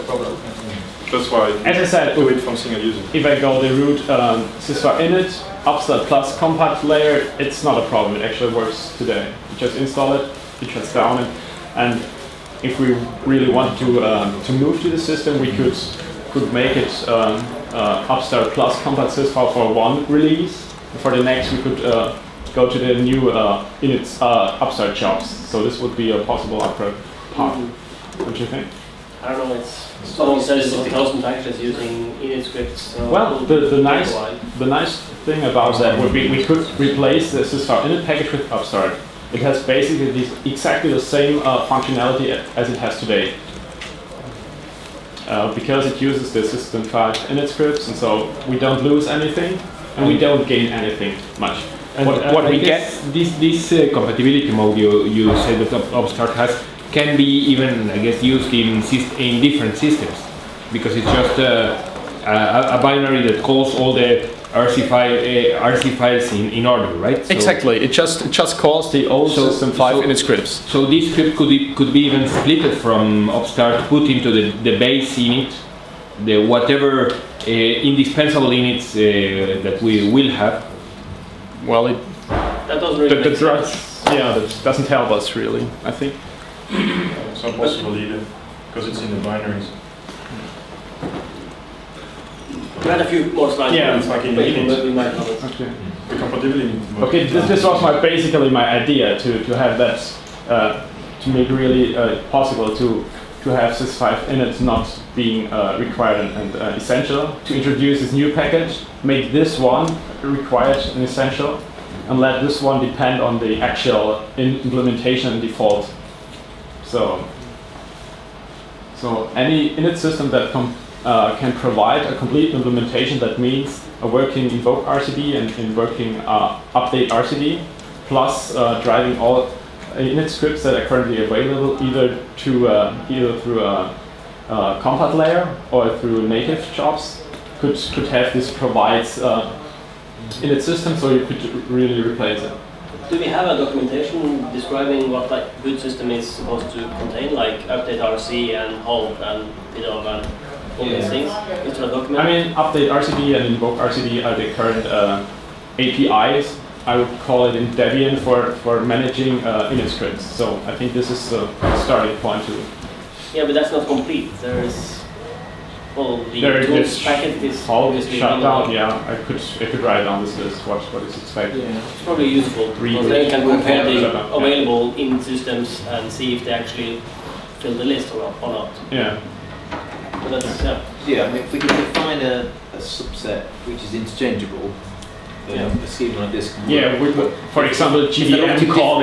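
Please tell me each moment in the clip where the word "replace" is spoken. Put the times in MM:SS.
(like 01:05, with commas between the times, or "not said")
00:36, 02:22.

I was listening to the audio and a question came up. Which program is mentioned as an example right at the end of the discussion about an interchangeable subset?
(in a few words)
GDM.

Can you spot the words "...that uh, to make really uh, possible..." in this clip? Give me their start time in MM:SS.
01:39.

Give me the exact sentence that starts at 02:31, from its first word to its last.
things I mean, update RCD and invoke RCD are the current uh, APIs.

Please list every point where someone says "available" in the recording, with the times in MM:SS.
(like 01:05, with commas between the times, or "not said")
02:11, 02:54.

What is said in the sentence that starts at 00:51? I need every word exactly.
And what, uh, what we get...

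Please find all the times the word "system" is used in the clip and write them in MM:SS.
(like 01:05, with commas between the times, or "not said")
00:14, 00:46, 00:59, 01:09, 01:59, 02:20, 02:25, 02:55.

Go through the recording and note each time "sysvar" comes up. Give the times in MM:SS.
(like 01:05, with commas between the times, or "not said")
00:04.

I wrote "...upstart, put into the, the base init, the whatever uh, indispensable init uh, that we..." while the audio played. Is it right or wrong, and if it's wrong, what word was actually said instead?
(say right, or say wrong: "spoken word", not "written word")
right.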